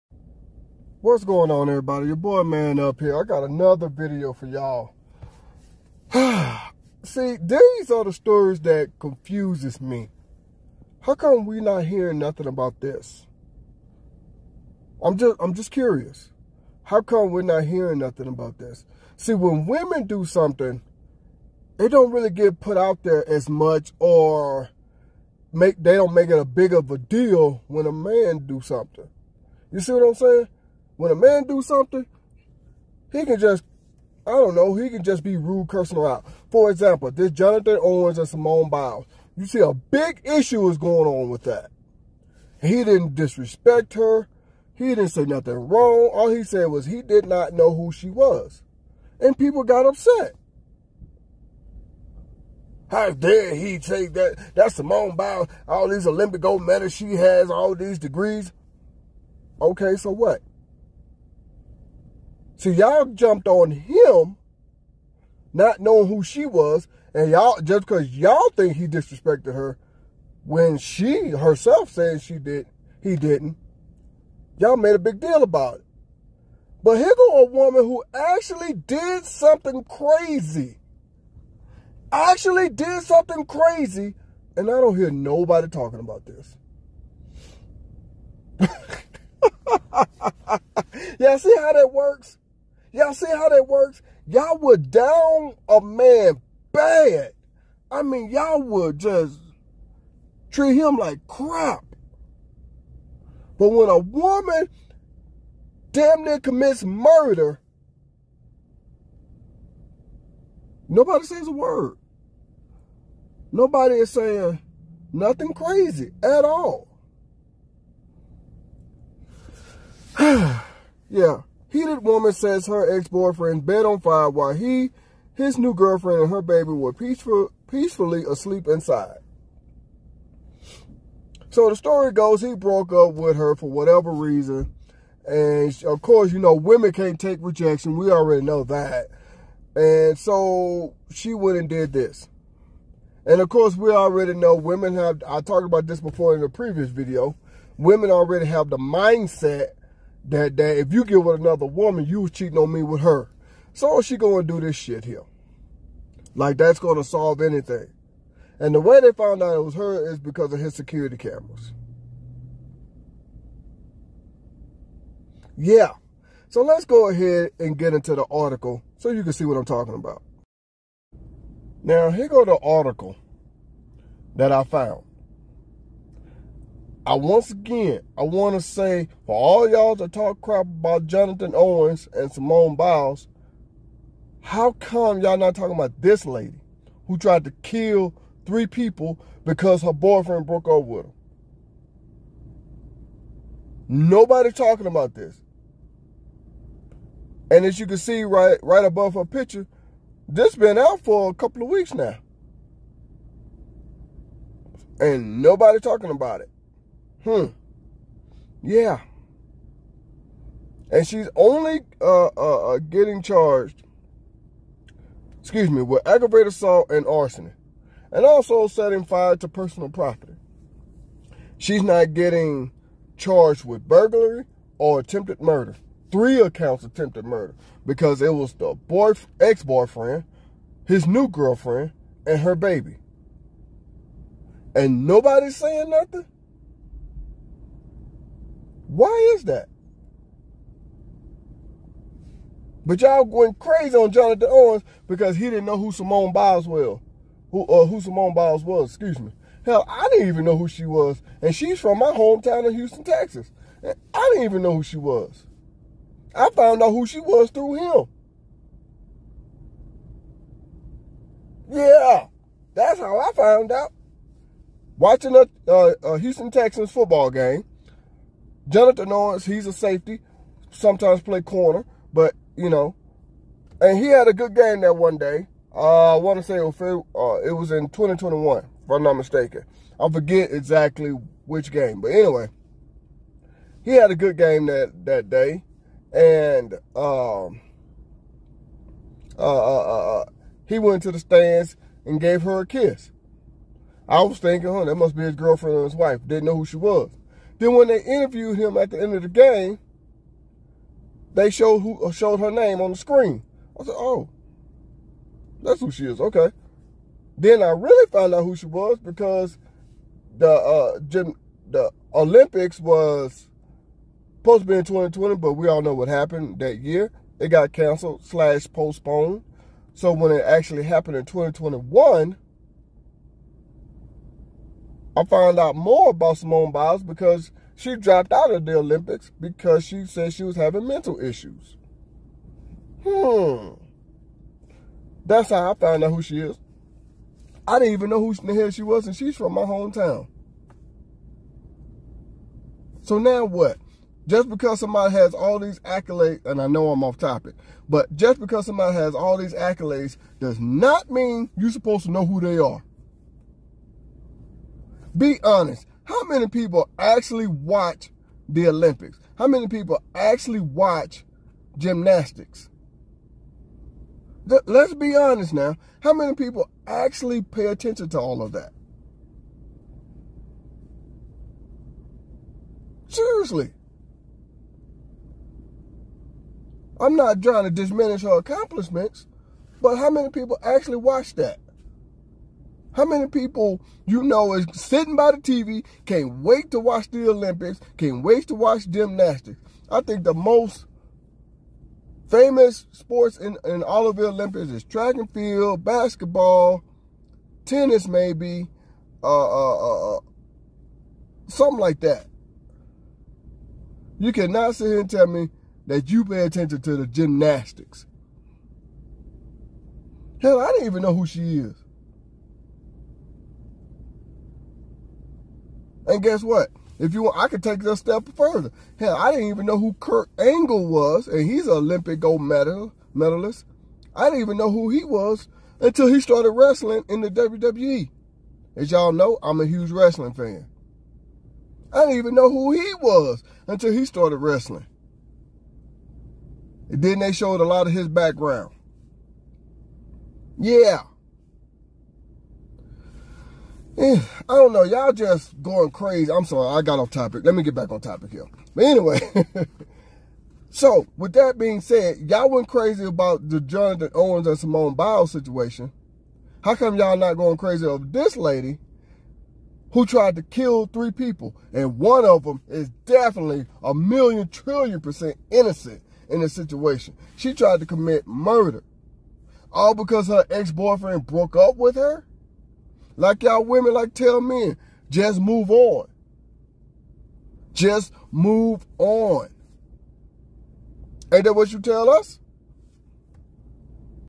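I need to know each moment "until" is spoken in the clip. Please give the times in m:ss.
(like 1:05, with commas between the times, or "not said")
7:05, 7:13.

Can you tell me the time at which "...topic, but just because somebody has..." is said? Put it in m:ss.
5:47.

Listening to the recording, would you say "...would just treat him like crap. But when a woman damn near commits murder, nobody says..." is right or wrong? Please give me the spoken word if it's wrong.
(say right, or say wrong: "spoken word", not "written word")
right.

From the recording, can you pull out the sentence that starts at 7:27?
Let me get back on topic here.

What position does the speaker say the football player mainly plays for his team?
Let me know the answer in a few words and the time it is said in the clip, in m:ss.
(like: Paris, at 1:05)
safety, at 4:29.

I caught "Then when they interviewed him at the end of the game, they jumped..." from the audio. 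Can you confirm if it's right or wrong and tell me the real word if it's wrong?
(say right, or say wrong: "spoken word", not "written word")
wrong: "showed", not "jumped".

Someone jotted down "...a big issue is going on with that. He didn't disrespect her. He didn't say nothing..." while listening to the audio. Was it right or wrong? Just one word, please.
right.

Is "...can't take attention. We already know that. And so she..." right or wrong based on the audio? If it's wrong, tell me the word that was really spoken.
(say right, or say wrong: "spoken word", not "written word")
wrong: "rejection", not "attention".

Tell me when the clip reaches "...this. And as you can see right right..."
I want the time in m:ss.
3:15.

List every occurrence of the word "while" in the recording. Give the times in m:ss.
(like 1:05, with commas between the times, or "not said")
2:04.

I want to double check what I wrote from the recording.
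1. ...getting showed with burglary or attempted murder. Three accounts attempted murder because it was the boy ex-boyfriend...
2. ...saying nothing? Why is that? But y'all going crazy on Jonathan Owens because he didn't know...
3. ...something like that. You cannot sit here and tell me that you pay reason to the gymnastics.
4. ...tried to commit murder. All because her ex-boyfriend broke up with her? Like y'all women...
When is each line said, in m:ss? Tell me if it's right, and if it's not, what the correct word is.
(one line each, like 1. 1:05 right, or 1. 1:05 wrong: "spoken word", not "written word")
1. 3:42 wrong: "charged", not "showed"
2. 3:55 right
3. 6:41 wrong: "attention", not "reason"
4. 7:47 right.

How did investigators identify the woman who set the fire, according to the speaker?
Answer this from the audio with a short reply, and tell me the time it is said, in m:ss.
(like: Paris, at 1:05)
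security cameras, at 2:40.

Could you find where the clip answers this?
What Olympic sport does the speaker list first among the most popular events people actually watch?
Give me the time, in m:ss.
6:34.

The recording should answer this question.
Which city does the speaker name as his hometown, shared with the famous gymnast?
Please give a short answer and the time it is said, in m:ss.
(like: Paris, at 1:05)
Houston, Texas, at 4:12.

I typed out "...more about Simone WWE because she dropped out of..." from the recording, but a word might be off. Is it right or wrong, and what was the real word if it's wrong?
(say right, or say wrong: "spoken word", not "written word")
wrong: "Biles", not "WWE".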